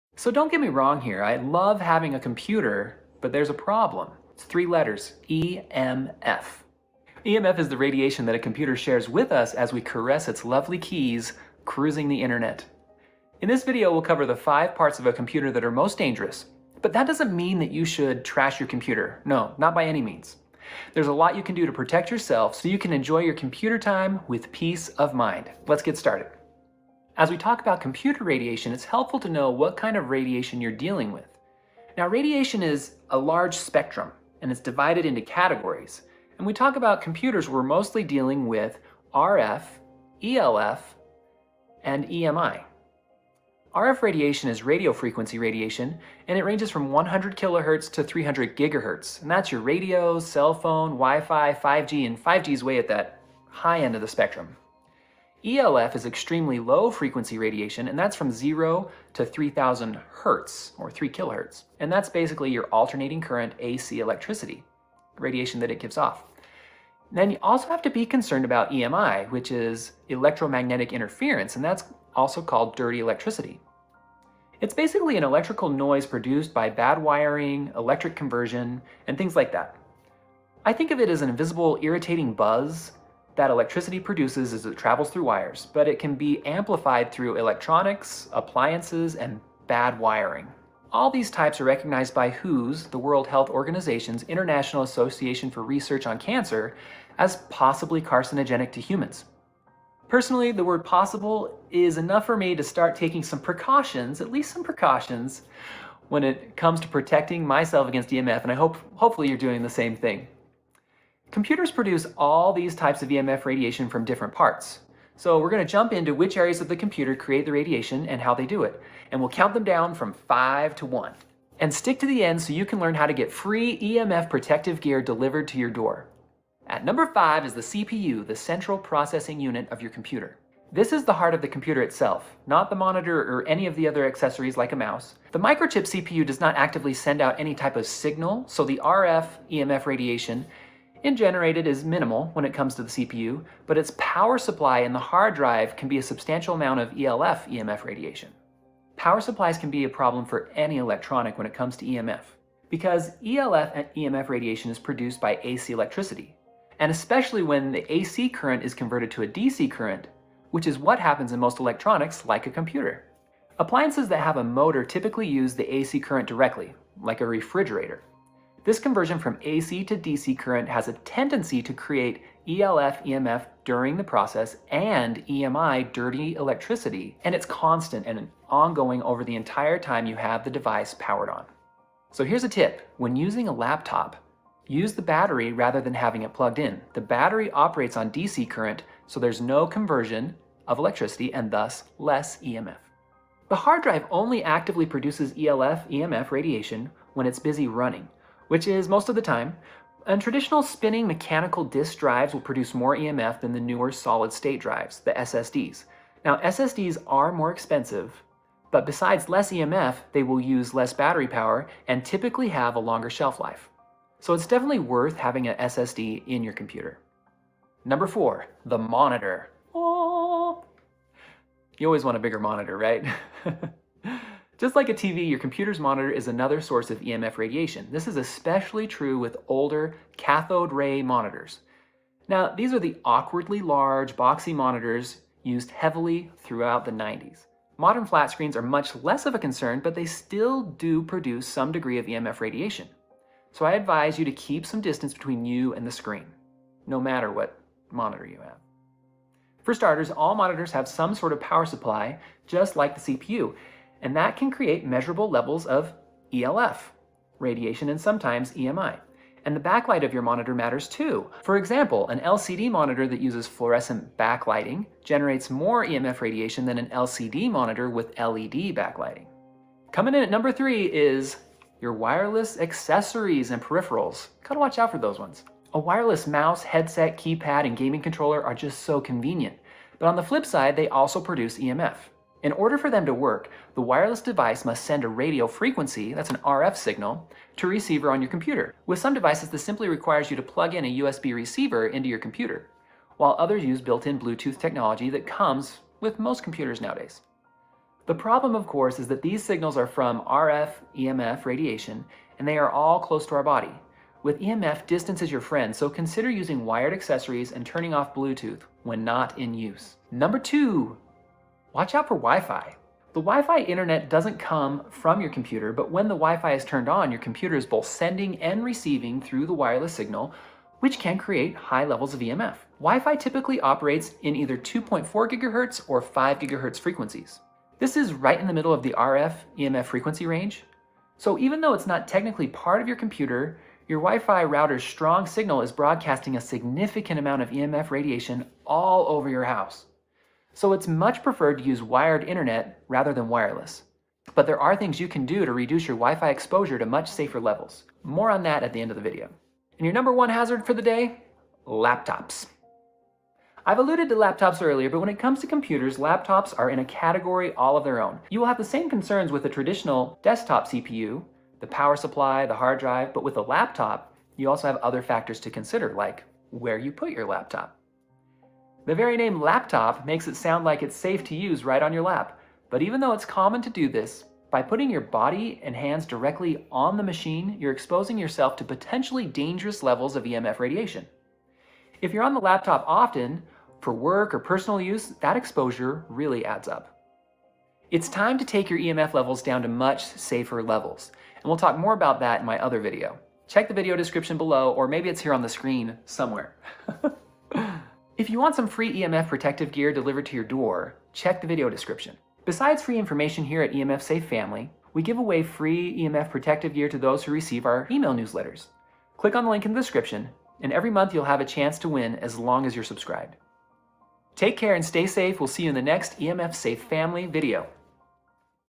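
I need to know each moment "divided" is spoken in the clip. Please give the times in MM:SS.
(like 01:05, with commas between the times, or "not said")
00:34.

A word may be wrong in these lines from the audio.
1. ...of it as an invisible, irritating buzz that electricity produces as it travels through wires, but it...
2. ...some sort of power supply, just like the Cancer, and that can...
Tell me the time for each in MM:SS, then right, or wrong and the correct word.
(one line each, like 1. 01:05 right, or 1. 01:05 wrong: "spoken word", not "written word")
1. 01:20 right
2. 04:10 wrong: "CPU", not "Cancer".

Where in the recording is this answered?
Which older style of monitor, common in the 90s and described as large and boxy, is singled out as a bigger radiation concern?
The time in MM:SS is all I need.
03:50.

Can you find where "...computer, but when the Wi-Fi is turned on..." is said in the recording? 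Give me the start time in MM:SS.
05:15.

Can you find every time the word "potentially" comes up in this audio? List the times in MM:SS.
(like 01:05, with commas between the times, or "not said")
06:18.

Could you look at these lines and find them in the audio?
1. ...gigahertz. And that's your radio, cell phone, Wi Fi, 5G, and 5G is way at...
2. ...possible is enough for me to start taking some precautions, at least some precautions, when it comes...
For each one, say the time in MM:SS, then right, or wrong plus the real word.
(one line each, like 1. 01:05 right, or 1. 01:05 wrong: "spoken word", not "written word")
1. 00:48 right
2. 01:40 right.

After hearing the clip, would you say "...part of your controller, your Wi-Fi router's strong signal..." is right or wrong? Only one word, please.
wrong.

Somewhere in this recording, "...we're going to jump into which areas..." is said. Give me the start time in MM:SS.
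01:55.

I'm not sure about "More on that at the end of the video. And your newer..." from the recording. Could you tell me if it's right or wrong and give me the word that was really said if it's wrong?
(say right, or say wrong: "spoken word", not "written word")
wrong: "number", not "newer".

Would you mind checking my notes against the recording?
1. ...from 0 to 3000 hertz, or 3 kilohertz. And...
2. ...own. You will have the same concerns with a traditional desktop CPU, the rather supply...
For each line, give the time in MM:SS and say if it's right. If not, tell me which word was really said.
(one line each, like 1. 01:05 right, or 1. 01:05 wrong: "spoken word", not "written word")
1. 00:58 right
2. 05:58 wrong: "power", not "rather".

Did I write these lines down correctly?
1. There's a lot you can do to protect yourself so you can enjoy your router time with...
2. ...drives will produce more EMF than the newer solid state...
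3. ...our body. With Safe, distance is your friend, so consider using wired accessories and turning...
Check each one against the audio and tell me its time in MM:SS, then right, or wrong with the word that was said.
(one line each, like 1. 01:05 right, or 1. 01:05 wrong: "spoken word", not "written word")
1. 00:20 wrong: "computer", not "router"
2. 03:21 right
3. 05:03 wrong: "EMF", not "Safe".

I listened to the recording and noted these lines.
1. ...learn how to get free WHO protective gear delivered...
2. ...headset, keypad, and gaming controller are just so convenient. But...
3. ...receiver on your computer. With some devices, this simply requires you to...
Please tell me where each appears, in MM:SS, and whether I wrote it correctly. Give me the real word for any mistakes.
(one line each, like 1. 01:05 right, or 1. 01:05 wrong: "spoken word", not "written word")
1. 02:02 wrong: "EMF", not "WHO"
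2. 04:36 right
3. 04:47 right.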